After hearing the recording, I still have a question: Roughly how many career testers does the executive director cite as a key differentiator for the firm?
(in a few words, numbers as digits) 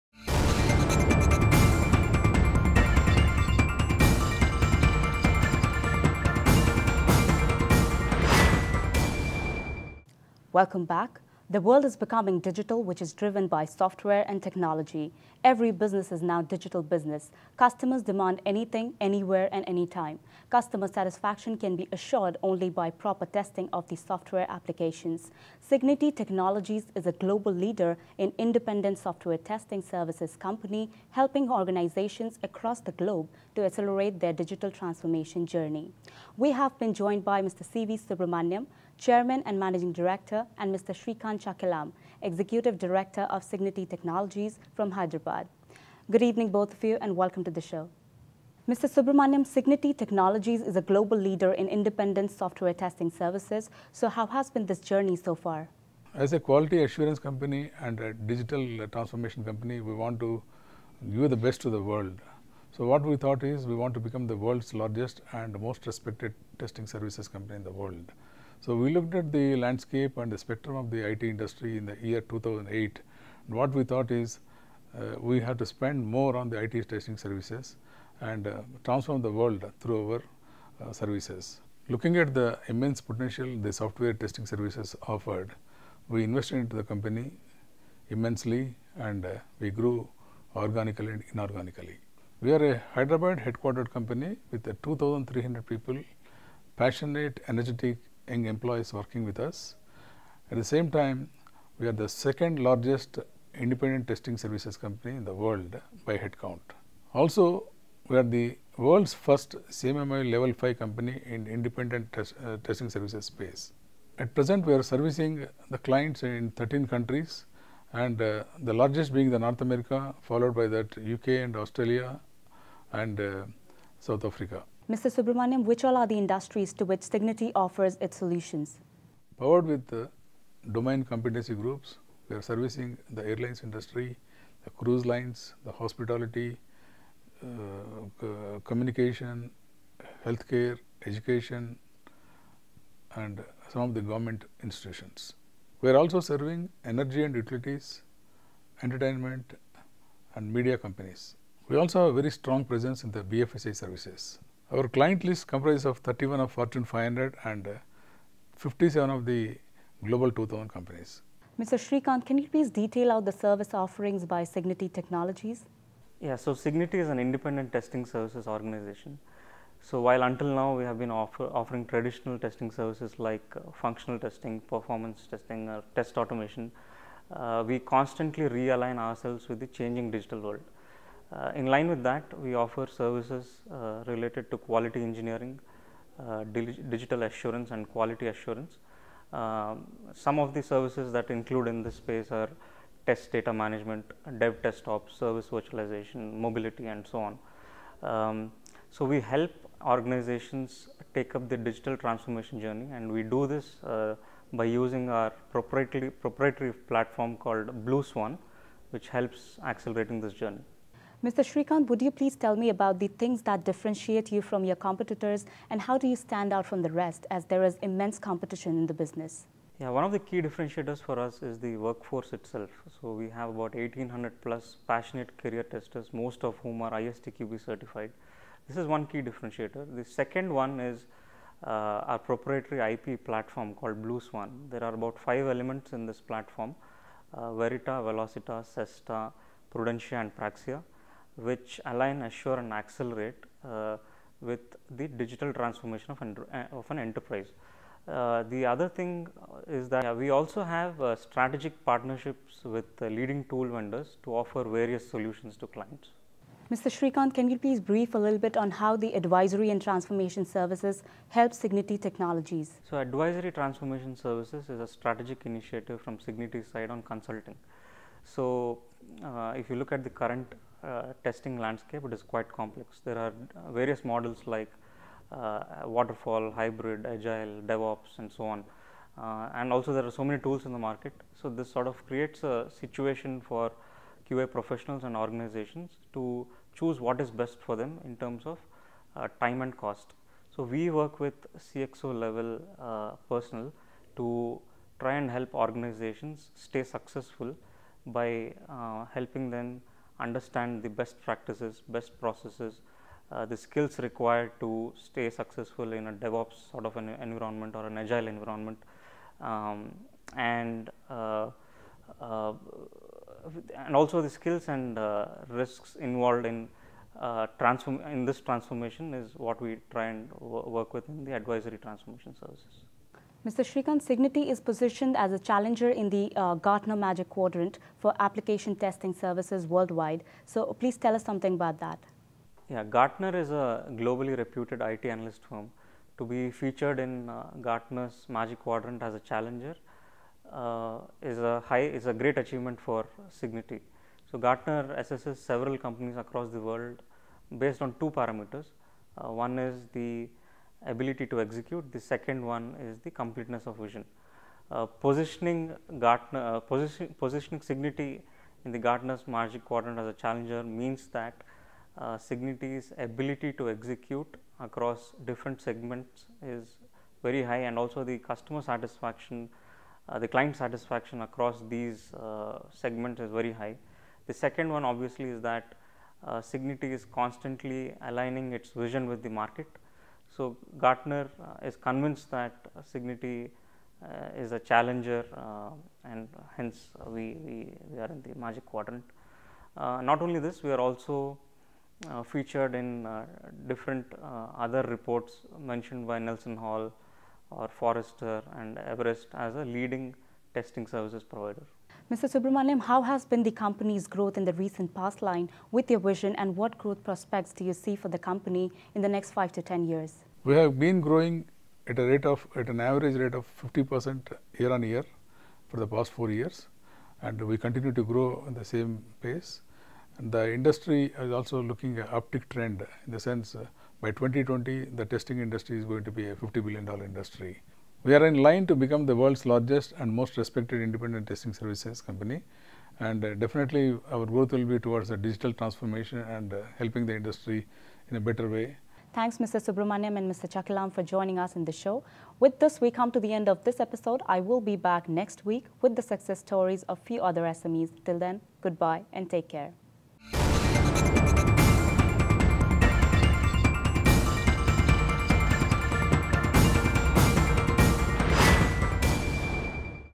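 1800.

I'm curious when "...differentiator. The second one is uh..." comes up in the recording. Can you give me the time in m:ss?
3:49.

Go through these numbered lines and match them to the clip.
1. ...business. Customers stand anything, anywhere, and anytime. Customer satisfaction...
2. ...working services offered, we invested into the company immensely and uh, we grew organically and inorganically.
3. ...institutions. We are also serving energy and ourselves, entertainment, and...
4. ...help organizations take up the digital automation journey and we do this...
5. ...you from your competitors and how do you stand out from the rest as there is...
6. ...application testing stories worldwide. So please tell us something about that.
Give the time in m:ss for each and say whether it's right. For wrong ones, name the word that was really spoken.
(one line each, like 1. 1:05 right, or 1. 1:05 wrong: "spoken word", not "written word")
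1. 0:16 wrong: "demand", not "stand"
2. 1:24 wrong: "testing", not "working"
3. 2:24 wrong: "utilities", not "ourselves"
4. 3:19 wrong: "transformation", not "automation"
5. 3:34 right
6. 5:28 wrong: "services", not "stories".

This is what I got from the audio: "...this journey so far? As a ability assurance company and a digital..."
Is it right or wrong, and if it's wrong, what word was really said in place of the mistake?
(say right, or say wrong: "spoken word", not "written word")
wrong: "quality", not "ability".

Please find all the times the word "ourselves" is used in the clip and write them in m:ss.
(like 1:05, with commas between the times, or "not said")
2:58.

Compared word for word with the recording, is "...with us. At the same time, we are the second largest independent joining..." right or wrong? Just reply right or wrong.
wrong.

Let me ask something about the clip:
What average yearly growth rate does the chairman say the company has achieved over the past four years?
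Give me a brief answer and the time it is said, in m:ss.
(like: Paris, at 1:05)
50 percent, at 6:53.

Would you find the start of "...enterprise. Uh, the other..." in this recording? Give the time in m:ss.
4:06.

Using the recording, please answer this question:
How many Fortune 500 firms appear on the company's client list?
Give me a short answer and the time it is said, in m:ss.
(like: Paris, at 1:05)
31, at 2:35.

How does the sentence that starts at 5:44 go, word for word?
So Gartner assesses several companies across the world based on two parameters.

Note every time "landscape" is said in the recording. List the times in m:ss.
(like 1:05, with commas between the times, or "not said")
1:09, 4:31.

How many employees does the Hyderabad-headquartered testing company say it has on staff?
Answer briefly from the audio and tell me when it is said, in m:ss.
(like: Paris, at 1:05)
2,300, at 1:34.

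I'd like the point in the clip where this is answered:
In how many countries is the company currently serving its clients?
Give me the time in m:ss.
1:56.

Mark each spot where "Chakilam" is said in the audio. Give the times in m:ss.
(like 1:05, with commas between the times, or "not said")
0:41, 7:20.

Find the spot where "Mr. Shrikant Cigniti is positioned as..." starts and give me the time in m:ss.
5:23.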